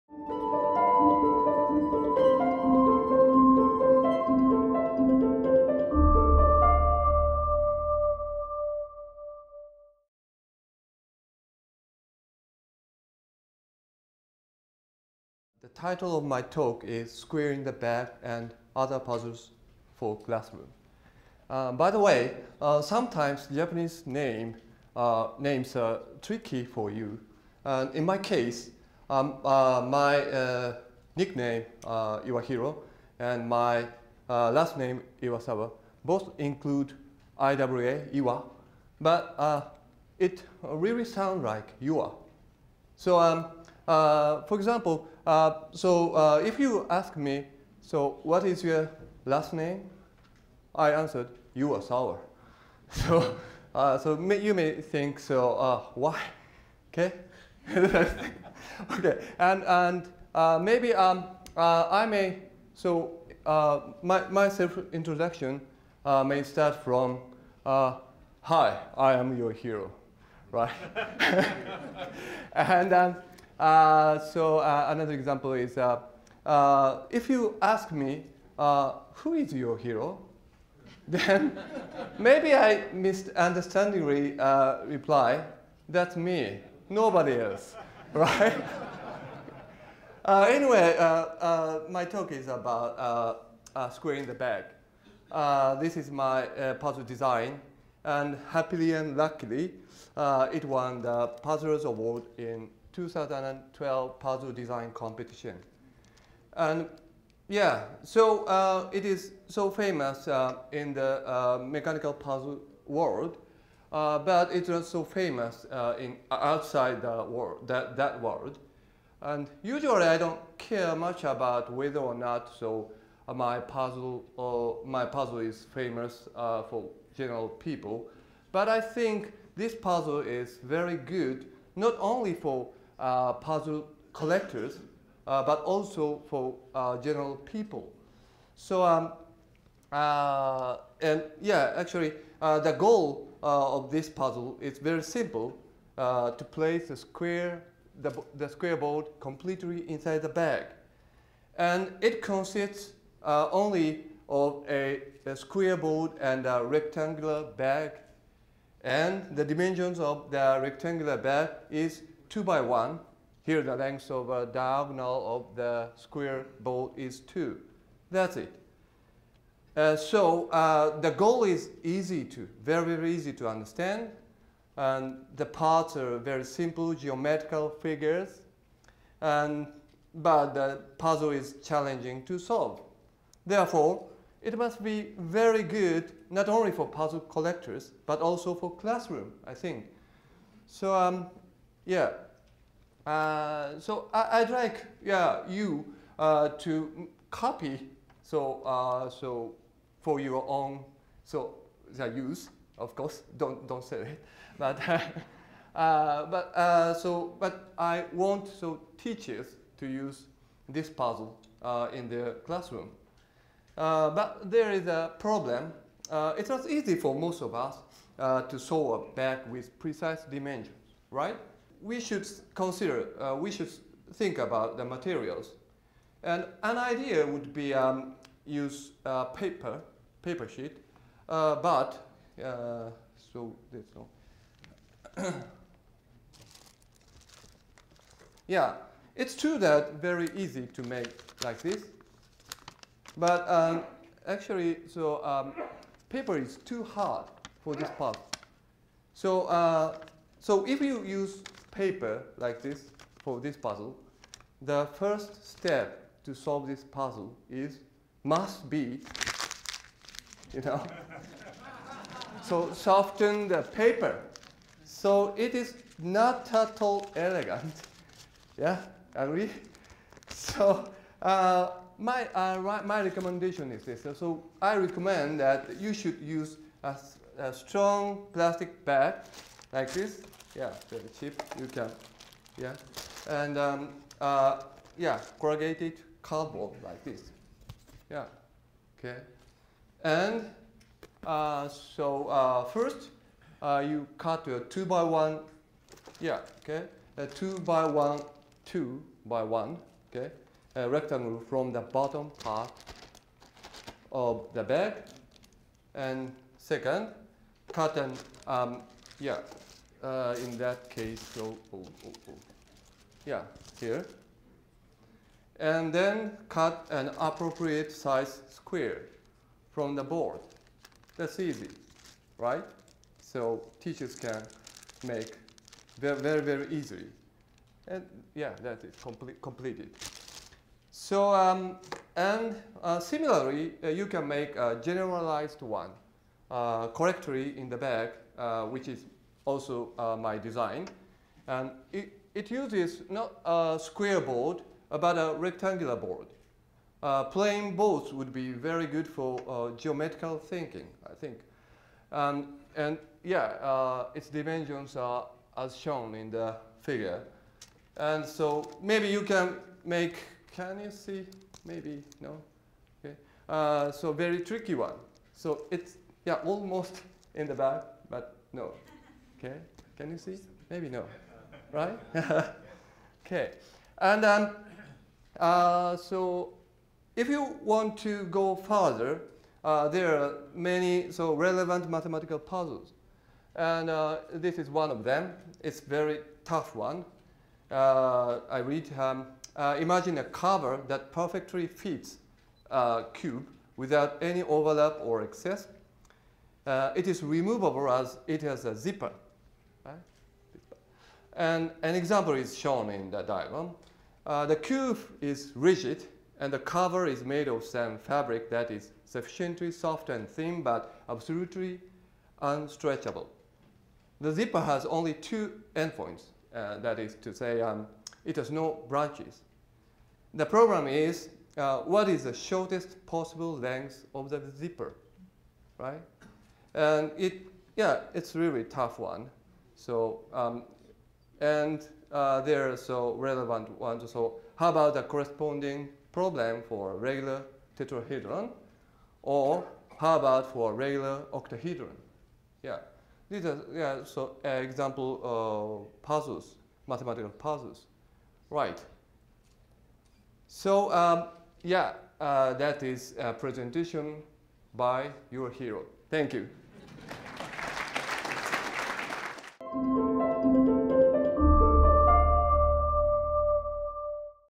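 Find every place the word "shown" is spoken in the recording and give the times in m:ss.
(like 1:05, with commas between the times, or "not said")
5:55, 6:42.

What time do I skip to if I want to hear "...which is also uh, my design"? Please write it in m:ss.
5:38.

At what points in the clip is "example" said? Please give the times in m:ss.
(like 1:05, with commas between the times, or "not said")
0:44, 1:15, 6:41, 7:24.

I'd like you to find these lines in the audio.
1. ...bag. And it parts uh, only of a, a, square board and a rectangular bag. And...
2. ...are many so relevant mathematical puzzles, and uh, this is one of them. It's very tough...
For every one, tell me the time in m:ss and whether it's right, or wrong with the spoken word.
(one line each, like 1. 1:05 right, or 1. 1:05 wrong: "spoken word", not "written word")
1. 2:30 wrong: "consists", not "parts"
2. 6:20 right.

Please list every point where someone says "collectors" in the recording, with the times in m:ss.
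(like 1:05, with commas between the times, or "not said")
2:14, 3:07.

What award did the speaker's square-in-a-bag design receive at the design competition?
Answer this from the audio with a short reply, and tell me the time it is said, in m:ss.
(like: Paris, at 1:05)
Puzzlers Award, at 1:41.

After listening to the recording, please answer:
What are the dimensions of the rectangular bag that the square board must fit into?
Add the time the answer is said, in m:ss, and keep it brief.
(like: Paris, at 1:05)
2 by 1, at 2:42.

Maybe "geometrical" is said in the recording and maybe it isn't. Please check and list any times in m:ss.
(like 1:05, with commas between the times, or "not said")
2:56, 5:49.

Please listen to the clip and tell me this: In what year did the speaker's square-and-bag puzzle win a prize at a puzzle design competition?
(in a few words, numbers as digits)
2012.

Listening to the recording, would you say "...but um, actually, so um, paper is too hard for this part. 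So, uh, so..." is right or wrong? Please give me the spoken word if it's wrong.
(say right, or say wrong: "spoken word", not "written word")
right.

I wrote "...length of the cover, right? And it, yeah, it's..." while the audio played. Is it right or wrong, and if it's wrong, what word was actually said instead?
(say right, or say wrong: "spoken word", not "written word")
wrong: "zipper", not "cover".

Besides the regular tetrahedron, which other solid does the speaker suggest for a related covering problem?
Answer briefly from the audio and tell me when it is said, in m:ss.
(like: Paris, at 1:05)
regular octahedron, at 7:20.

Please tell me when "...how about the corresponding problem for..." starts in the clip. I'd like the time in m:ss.
7:14.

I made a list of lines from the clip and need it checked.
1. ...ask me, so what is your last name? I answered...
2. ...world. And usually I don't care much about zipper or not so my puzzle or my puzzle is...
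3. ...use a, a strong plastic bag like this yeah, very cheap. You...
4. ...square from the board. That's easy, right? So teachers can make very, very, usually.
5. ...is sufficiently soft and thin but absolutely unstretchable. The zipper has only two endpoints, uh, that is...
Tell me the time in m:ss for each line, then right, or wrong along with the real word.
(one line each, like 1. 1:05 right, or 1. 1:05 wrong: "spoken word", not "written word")
1. 0:46 right
2. 1:58 wrong: "whether", not "zipper"
3. 4:36 right
4. 5:18 wrong: "easily", not "usually"
5. 6:48 right.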